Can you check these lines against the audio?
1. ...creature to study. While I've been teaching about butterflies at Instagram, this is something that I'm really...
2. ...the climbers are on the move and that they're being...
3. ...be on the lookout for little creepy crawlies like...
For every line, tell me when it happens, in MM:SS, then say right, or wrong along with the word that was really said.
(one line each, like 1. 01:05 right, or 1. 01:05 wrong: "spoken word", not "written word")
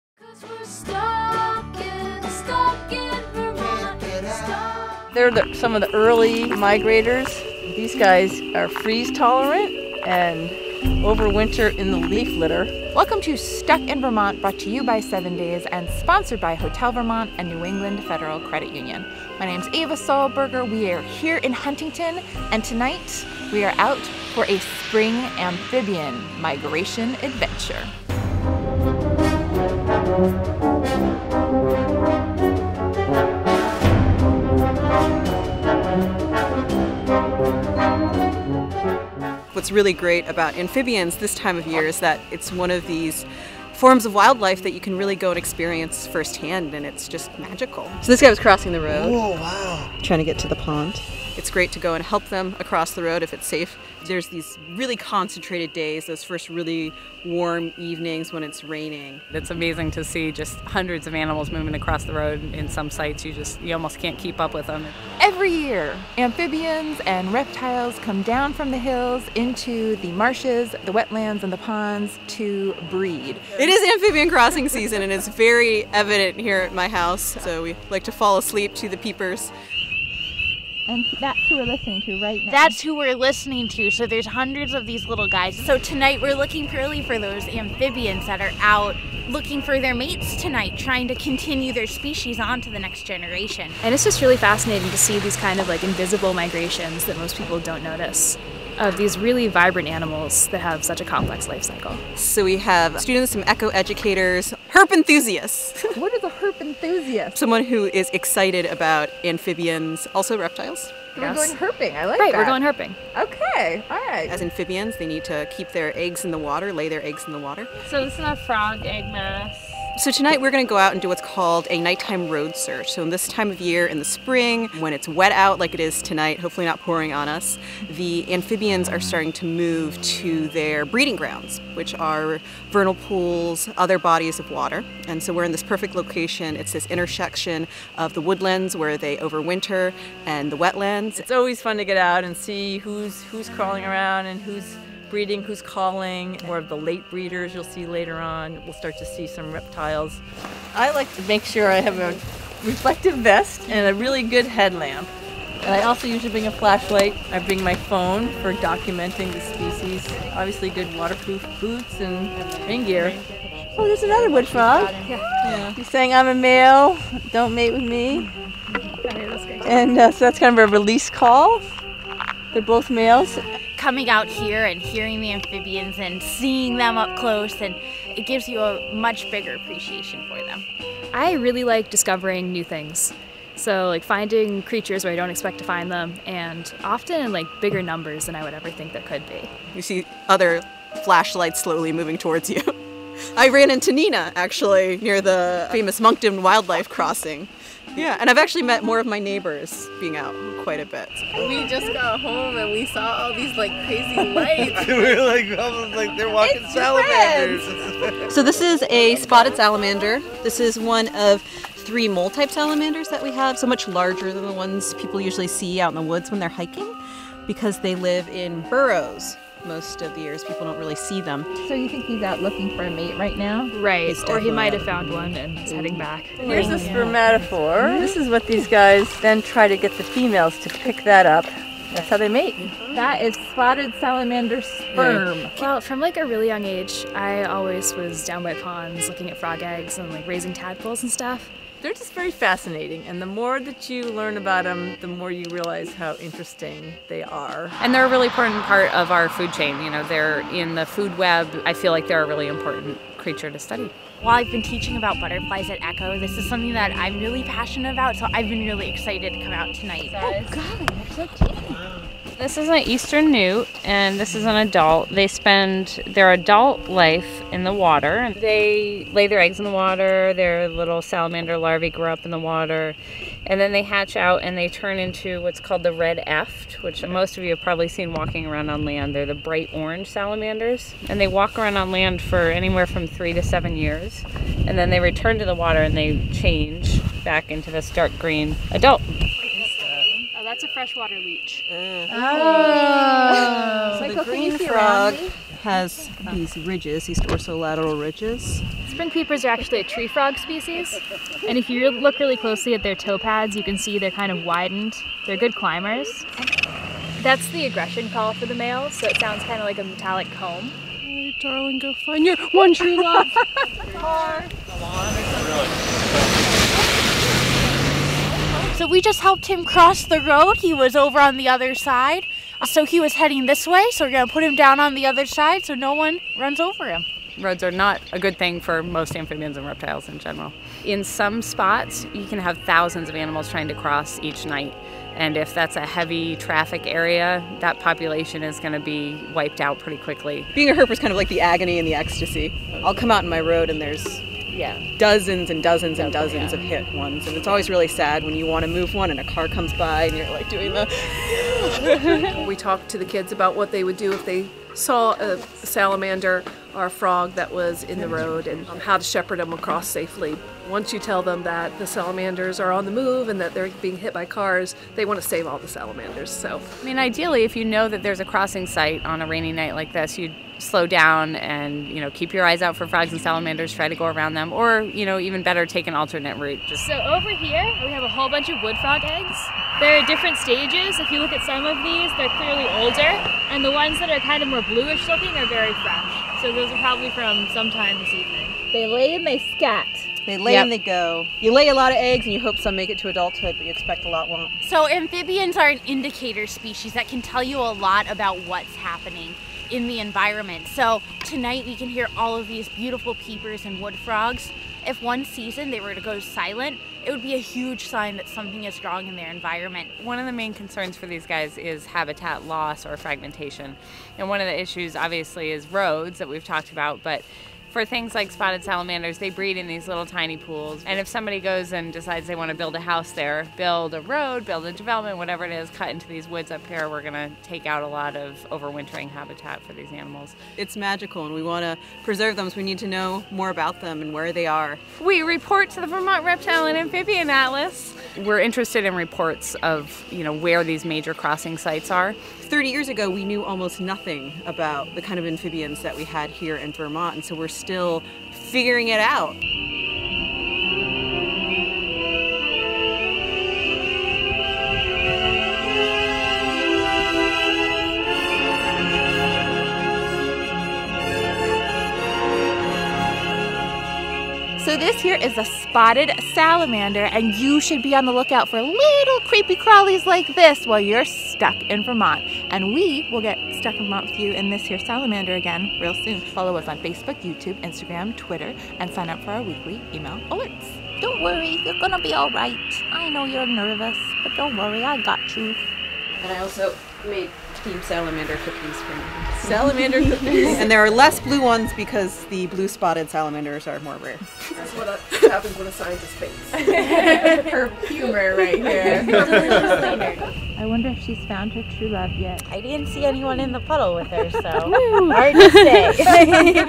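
1. 04:13 wrong: "Echo", not "Instagram"
2. 06:01 wrong: "salamanders", not "climbers"
3. 07:47 right.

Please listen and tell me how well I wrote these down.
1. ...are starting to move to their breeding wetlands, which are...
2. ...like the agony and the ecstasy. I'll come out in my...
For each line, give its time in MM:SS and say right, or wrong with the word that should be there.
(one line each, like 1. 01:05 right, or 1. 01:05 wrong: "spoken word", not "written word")
1. 02:08 wrong: "grounds", not "wetlands"
2. 05:41 right.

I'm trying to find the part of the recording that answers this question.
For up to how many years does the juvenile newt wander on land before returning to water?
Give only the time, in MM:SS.
04:43.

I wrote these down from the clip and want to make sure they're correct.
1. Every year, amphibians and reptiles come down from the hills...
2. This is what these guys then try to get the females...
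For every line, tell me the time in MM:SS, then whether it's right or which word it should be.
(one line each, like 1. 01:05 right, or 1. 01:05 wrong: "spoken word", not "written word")
1. 01:05 right
2. 03:47 right.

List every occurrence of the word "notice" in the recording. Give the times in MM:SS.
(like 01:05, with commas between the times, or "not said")
01:37.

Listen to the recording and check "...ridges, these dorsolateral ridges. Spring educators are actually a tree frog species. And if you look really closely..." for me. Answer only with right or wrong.
wrong.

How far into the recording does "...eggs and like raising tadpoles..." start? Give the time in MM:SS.
03:59.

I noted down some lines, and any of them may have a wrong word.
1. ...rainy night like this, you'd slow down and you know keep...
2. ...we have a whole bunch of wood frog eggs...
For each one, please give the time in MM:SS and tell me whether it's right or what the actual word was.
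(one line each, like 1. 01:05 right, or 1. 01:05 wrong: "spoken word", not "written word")
1. 06:09 right
2. 06:17 right.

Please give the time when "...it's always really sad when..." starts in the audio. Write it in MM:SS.
05:47.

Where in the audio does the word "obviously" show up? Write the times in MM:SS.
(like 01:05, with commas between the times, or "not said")
02:40, 06:54.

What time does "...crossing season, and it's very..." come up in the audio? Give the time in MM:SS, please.
01:14.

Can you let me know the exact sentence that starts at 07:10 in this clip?
It's magical, and we want to preserve them, so we need to know more about them and where they are.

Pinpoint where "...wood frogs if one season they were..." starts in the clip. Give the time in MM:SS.
06:43.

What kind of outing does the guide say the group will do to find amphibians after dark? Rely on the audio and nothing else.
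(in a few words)
nighttime road search.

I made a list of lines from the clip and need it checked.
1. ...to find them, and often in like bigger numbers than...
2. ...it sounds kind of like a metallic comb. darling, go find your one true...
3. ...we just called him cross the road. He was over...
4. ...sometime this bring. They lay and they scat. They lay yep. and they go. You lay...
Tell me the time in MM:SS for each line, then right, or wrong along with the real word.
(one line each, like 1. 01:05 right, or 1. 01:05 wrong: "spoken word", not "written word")
1. 03:05 right
2. 05:09 right
3. 05:18 wrong: "helped", not "called"
4. 06:27 wrong: "evening", not "bring".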